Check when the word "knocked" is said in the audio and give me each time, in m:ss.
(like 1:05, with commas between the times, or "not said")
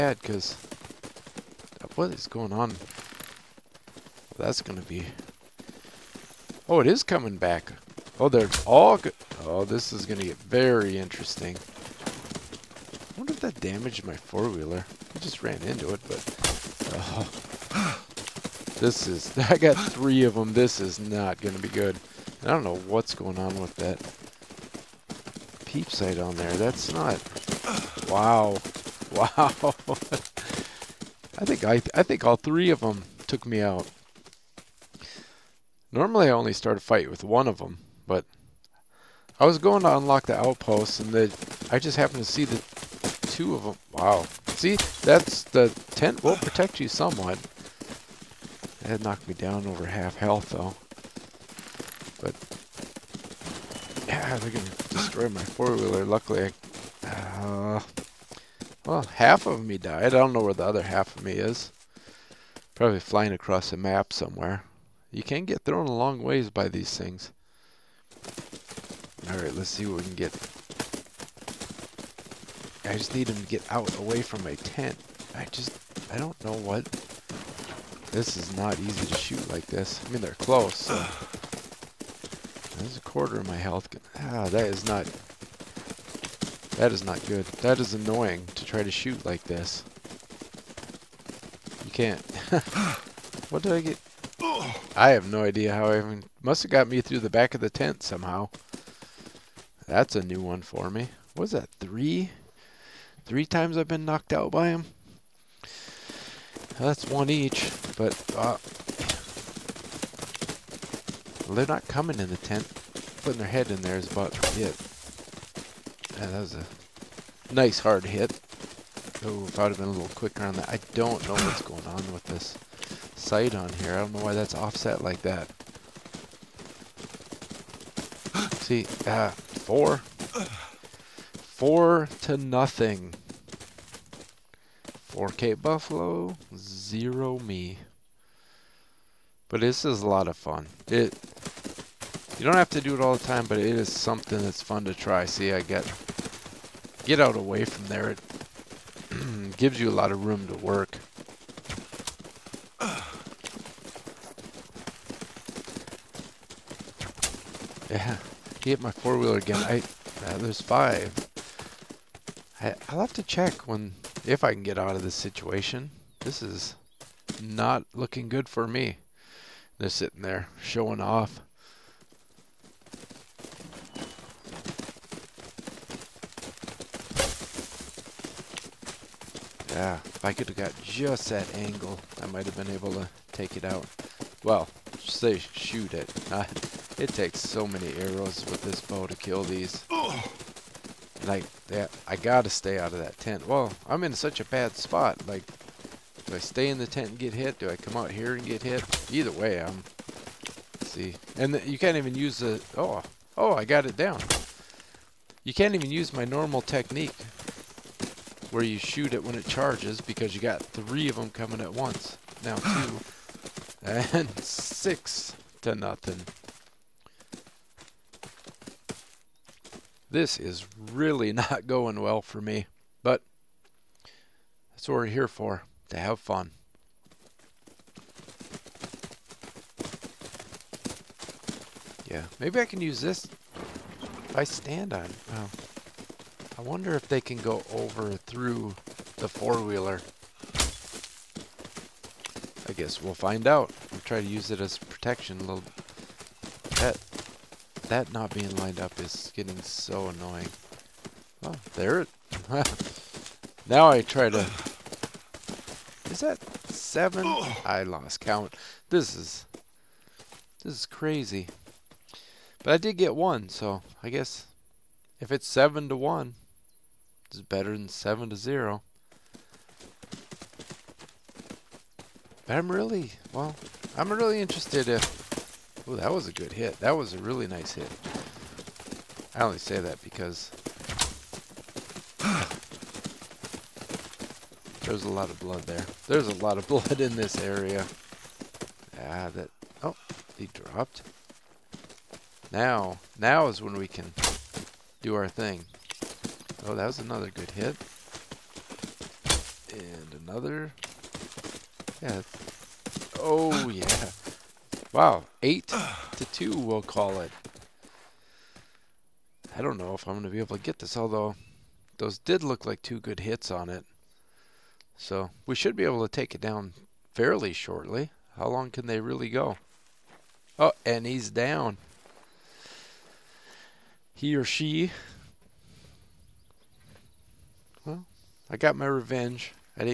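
0:49, 1:44.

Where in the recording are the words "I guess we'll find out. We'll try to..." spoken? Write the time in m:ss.
4:02.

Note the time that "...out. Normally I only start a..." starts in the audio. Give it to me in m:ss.
0:33.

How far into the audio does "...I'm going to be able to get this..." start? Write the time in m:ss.
5:10.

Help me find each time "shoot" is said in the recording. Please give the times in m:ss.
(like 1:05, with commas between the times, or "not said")
1:19, 1:28, 3:05, 3:28.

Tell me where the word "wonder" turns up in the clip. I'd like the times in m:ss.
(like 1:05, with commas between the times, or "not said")
0:13, 3:56.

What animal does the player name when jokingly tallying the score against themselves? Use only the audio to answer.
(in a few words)
Buffalo.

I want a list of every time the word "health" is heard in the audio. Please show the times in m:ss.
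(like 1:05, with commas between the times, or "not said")
0:50, 1:23.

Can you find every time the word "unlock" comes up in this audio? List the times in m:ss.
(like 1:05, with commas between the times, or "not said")
0:39.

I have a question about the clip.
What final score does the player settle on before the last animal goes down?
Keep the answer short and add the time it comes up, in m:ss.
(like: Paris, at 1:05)
8 to 2, at 5:05.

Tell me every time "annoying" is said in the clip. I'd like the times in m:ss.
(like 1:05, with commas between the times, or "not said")
1:27, 4:10.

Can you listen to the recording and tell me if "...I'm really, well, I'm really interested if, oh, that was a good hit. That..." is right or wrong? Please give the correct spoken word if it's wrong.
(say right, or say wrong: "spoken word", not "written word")
right.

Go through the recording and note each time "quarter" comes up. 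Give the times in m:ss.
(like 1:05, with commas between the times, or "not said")
1:23.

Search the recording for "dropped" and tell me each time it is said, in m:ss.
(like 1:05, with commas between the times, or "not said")
4:50.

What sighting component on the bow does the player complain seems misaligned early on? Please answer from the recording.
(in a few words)
peep sight.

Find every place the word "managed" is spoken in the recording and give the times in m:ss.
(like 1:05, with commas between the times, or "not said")
not said.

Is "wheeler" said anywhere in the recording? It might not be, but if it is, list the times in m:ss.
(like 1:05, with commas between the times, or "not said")
0:14, 0:55, 2:38, 3:59.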